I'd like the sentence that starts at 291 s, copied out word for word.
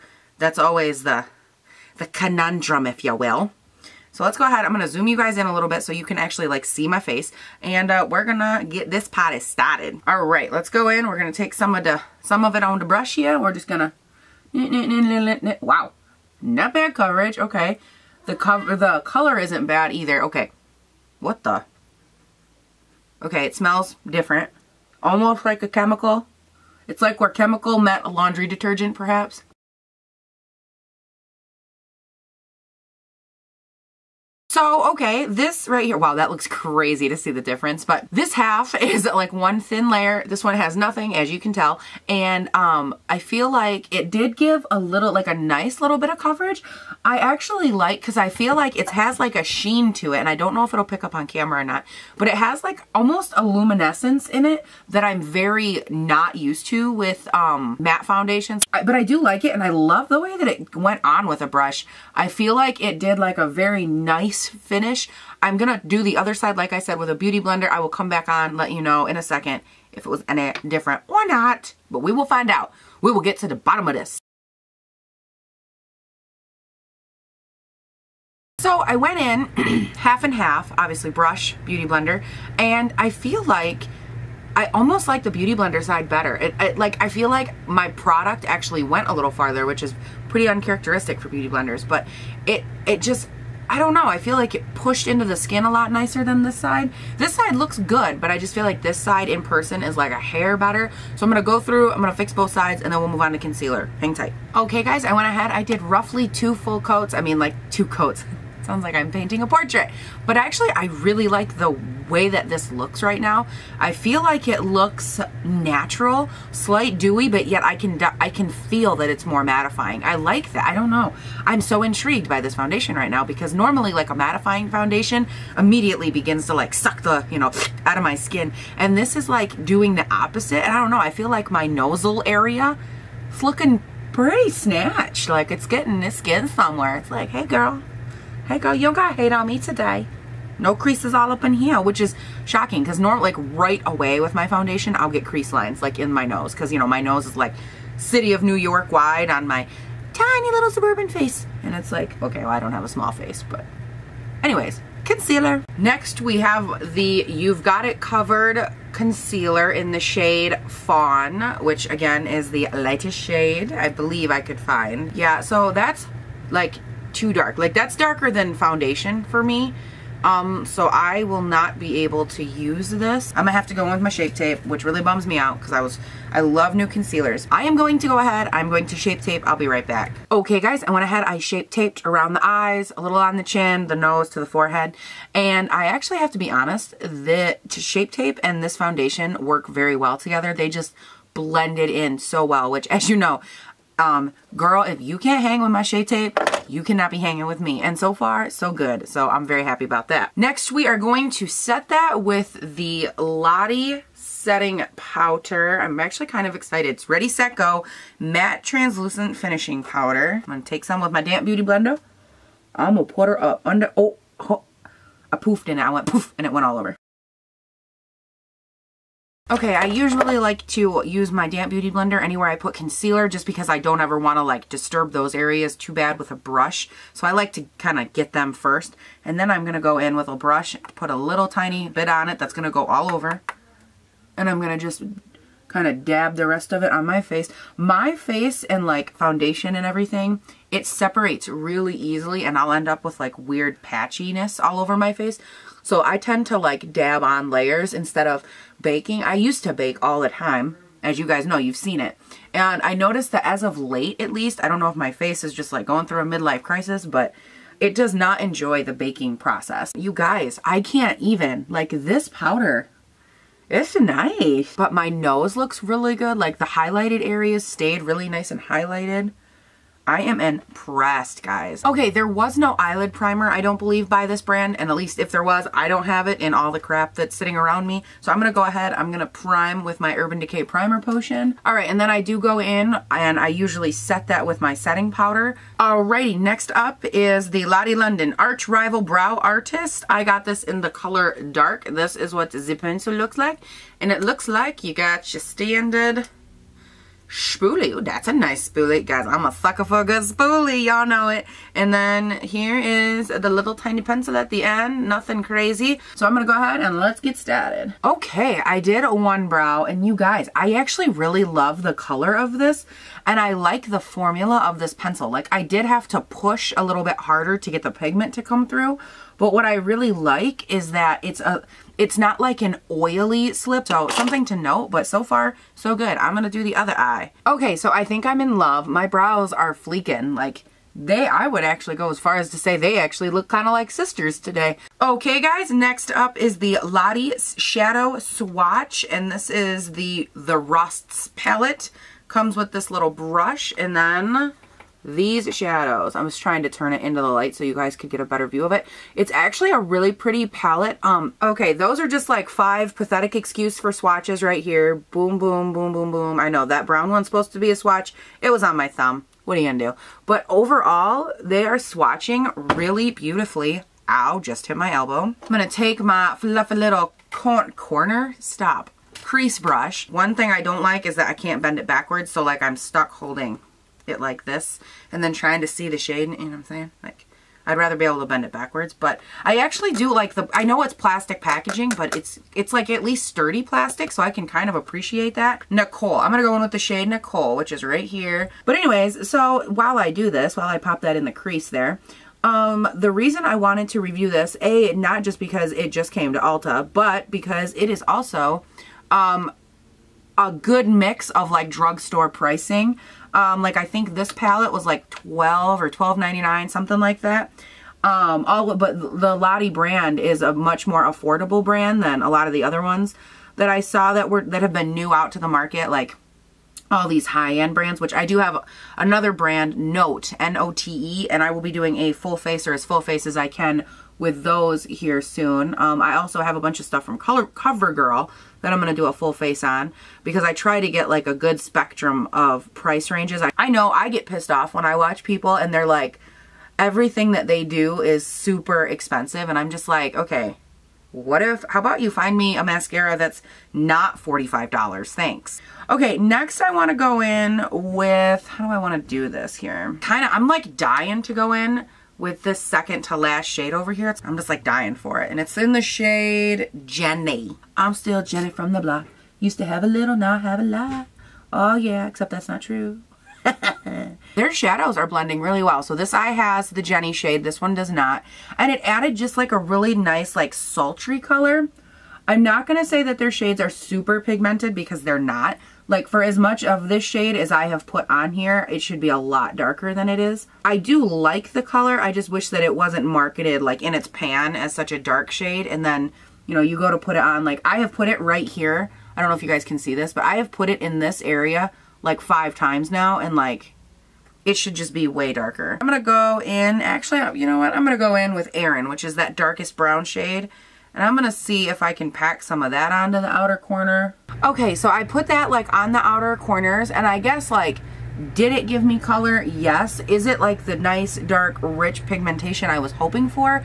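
This is what the pencil looks like.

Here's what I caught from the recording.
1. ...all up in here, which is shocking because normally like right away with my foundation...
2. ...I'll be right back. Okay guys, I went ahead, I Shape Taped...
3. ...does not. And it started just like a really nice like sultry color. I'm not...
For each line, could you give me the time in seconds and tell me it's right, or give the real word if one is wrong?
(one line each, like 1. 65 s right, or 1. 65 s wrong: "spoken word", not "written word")
1. 141 s right
2. 179 s right
3. 467 s wrong: "added", not "started".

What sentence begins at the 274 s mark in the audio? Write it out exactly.
And at least if there was, I don't have it in all the crap that's sitting around me.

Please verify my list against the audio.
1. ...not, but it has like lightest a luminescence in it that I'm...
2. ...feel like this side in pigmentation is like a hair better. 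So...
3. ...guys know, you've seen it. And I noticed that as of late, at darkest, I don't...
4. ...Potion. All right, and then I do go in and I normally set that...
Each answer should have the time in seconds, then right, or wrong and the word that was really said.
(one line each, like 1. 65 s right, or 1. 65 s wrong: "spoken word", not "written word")
1. 51 s wrong: "almost", not "lightest"
2. 98 s wrong: "person", not "pigmentation"
3. 251 s wrong: "least", not "darkest"
4. 280 s wrong: "usually", not "normally".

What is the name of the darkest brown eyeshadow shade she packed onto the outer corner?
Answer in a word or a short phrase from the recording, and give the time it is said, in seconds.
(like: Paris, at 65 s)
Erin, at 498 s.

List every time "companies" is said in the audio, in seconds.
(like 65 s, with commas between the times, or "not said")
not said.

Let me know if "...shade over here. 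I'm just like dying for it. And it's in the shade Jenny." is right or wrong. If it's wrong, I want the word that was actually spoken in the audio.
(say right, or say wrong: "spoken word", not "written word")
right.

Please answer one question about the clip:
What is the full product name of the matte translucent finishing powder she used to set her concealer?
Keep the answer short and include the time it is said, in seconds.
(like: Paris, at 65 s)
Ready, Set, Go, at 207 s.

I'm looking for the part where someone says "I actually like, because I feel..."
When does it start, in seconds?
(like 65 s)
47 s.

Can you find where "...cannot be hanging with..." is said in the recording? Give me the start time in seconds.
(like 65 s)
196 s.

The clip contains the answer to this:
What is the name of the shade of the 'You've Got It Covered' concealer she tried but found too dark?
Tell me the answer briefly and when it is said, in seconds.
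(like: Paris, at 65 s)
Fawn, at 160 s.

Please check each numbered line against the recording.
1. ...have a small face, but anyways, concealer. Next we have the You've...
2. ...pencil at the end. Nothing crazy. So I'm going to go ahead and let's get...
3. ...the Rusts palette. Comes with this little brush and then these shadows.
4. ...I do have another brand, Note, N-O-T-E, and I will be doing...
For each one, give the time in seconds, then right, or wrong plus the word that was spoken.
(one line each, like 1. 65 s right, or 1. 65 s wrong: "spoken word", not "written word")
1. 152 s right
2. 304 s right
3. 340 s right
4. 418 s right.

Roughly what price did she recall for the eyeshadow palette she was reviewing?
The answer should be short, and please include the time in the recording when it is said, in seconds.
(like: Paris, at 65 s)
$12.99, at 405 s.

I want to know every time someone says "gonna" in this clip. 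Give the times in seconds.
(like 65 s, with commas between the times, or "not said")
173 s, 359 s, 365 s, 386 s.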